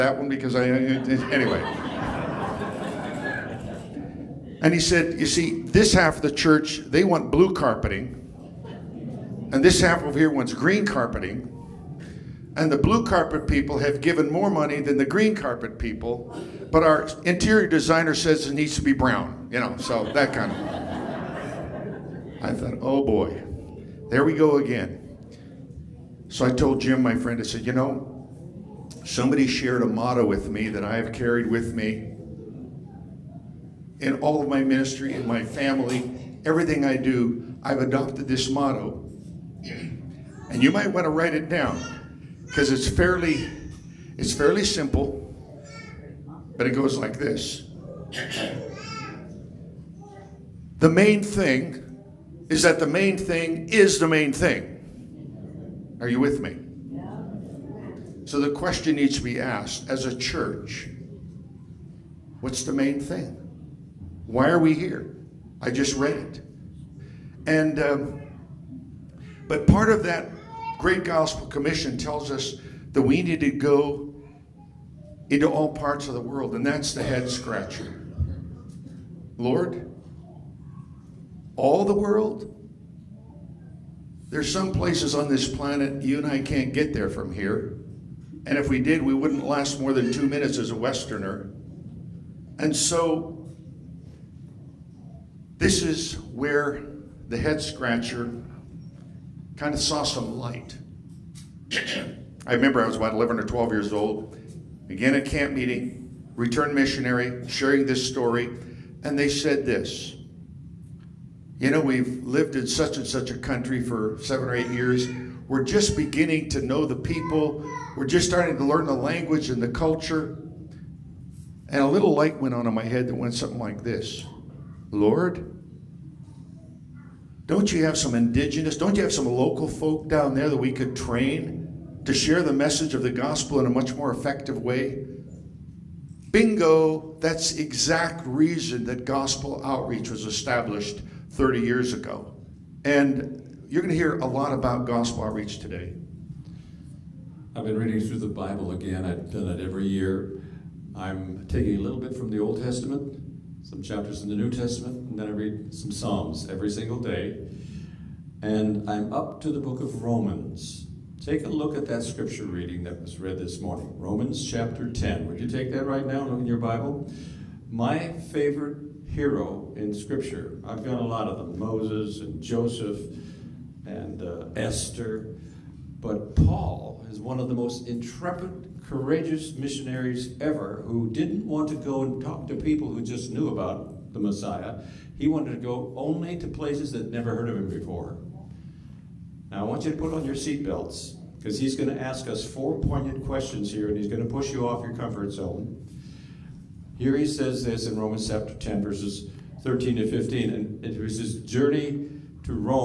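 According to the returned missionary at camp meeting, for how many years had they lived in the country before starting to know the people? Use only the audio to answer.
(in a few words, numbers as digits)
7 or 8 years.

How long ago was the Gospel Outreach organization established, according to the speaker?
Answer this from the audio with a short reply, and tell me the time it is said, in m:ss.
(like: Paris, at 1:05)
30 years ago, at 2:21.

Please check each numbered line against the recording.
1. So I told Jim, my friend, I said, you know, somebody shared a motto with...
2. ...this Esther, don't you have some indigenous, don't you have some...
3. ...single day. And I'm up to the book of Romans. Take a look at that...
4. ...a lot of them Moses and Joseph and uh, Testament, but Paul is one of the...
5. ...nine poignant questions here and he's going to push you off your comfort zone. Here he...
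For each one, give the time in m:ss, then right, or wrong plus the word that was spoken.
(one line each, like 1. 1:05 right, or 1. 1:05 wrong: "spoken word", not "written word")
1. 0:26 right
2. 2:03 wrong: "Lord", not "Esther"
3. 2:36 right
4. 2:51 wrong: "Esther", not "Testament"
5. 3:12 wrong: "four", not "nine".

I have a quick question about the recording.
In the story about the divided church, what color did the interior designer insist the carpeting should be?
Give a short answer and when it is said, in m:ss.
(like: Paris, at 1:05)
Brown, at 0:18.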